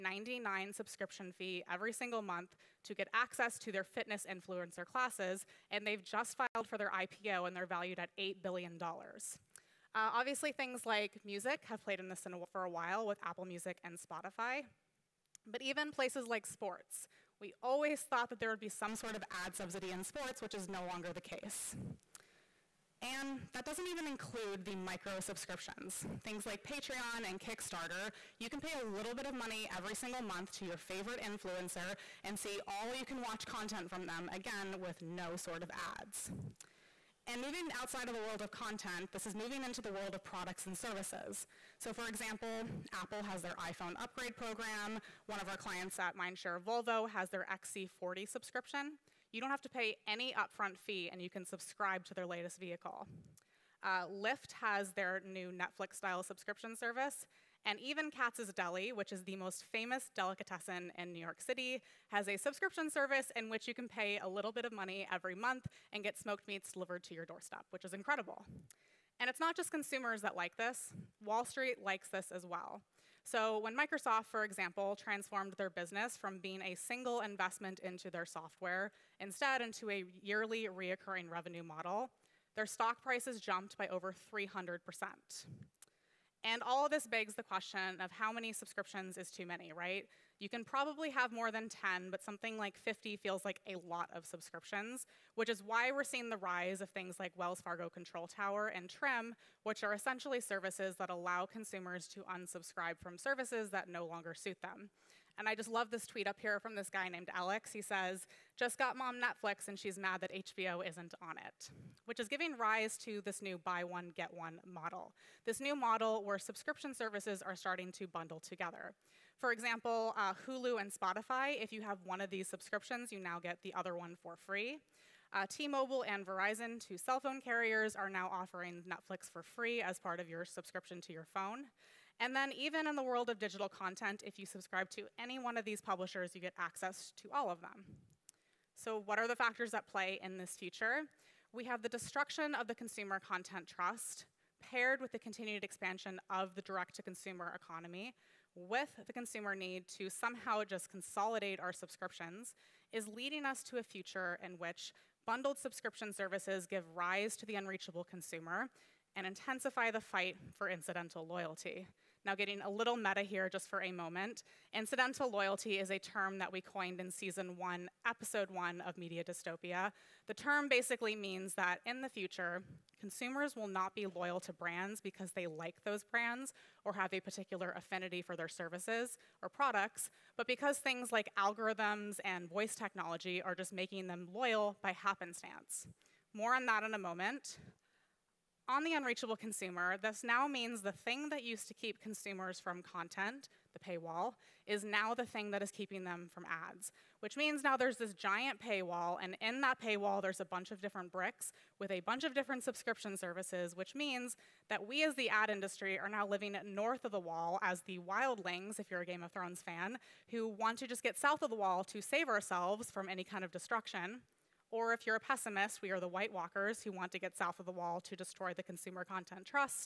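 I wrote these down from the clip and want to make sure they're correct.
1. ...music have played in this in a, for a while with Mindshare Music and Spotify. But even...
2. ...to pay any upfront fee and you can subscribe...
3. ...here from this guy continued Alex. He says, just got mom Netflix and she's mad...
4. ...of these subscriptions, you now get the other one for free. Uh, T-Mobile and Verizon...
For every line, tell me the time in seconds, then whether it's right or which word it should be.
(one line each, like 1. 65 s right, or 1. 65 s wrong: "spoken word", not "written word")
1. 11 s wrong: "Apple", not "Mindshare"
2. 49 s right
3. 106 s wrong: "named", not "continued"
4. 122 s right.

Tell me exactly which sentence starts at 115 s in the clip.
This new model where subscription services are starting to bundle together.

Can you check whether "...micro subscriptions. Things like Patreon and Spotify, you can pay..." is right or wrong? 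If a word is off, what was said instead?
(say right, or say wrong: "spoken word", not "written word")
wrong: "Kickstarter", not "Spotify".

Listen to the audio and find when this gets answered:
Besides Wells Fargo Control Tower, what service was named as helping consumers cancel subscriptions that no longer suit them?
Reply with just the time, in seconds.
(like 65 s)
98 s.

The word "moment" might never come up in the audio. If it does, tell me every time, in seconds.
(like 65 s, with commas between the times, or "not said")
163 s, 186 s.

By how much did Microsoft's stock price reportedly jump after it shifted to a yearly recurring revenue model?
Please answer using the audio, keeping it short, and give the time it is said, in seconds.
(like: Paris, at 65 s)
over 300 percent, at 83 s.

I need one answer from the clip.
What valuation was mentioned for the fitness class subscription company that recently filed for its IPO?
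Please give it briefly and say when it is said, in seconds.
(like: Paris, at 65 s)
$8 billion, at 8 s.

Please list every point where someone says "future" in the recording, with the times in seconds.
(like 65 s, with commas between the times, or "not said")
140 s, 153 s, 172 s.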